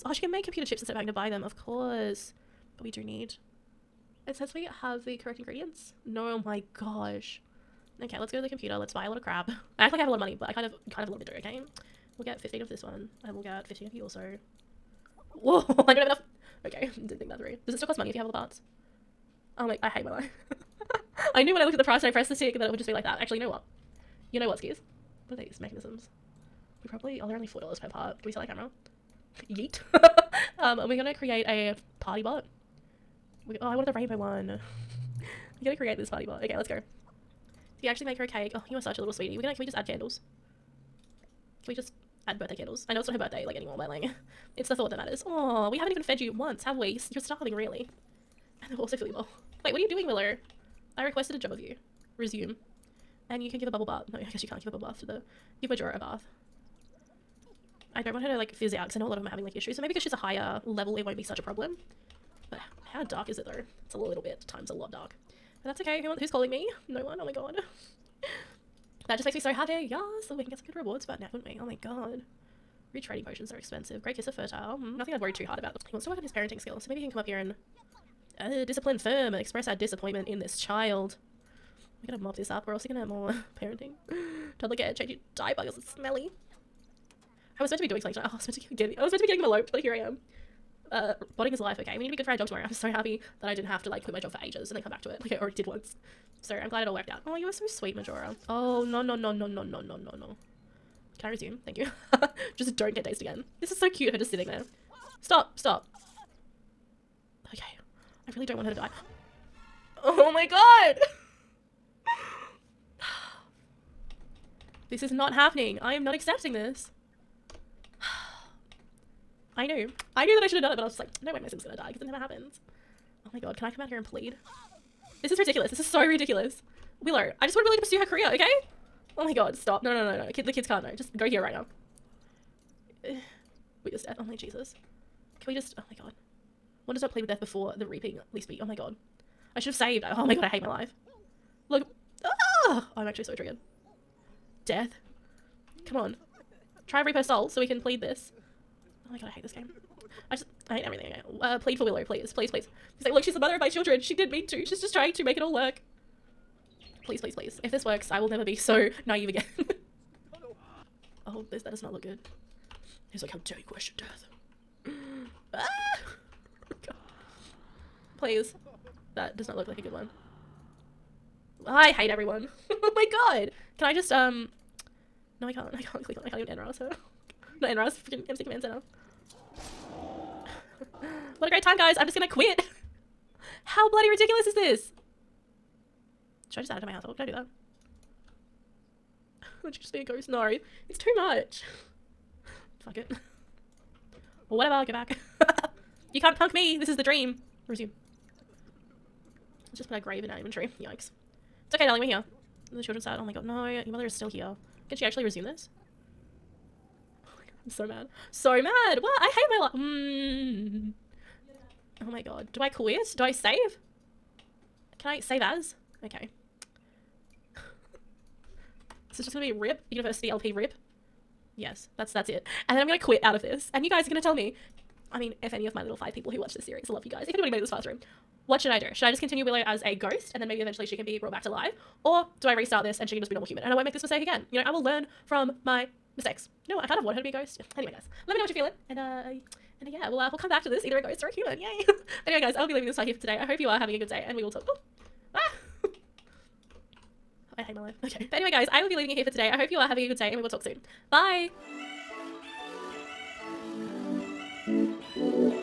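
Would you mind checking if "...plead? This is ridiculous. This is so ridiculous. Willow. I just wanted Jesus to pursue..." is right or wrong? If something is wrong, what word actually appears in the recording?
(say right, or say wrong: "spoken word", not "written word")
wrong: "Willow", not "Jesus".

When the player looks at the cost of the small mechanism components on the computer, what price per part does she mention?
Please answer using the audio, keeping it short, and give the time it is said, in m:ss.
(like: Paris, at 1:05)
$4, at 0:27.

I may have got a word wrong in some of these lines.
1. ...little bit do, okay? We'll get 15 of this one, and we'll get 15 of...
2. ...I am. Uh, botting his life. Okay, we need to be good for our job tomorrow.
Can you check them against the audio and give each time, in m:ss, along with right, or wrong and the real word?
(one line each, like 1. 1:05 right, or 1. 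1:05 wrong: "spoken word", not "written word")
1. 0:11 right
2. 1:29 right.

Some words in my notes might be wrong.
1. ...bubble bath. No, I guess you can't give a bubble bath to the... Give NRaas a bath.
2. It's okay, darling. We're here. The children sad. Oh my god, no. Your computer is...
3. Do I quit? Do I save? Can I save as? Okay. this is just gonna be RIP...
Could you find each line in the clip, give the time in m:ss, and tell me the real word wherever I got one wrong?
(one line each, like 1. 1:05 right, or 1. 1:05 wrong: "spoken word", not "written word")
1. 0:53 wrong: "Majora", not "NRaas"
2. 3:21 wrong: "mother", not "computer"
3. 3:32 right.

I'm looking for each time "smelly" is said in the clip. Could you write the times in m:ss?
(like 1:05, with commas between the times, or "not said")
1:25.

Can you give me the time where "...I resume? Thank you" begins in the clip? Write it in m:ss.
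1:41.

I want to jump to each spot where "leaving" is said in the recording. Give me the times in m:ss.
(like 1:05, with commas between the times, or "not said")
4:02, 4:08.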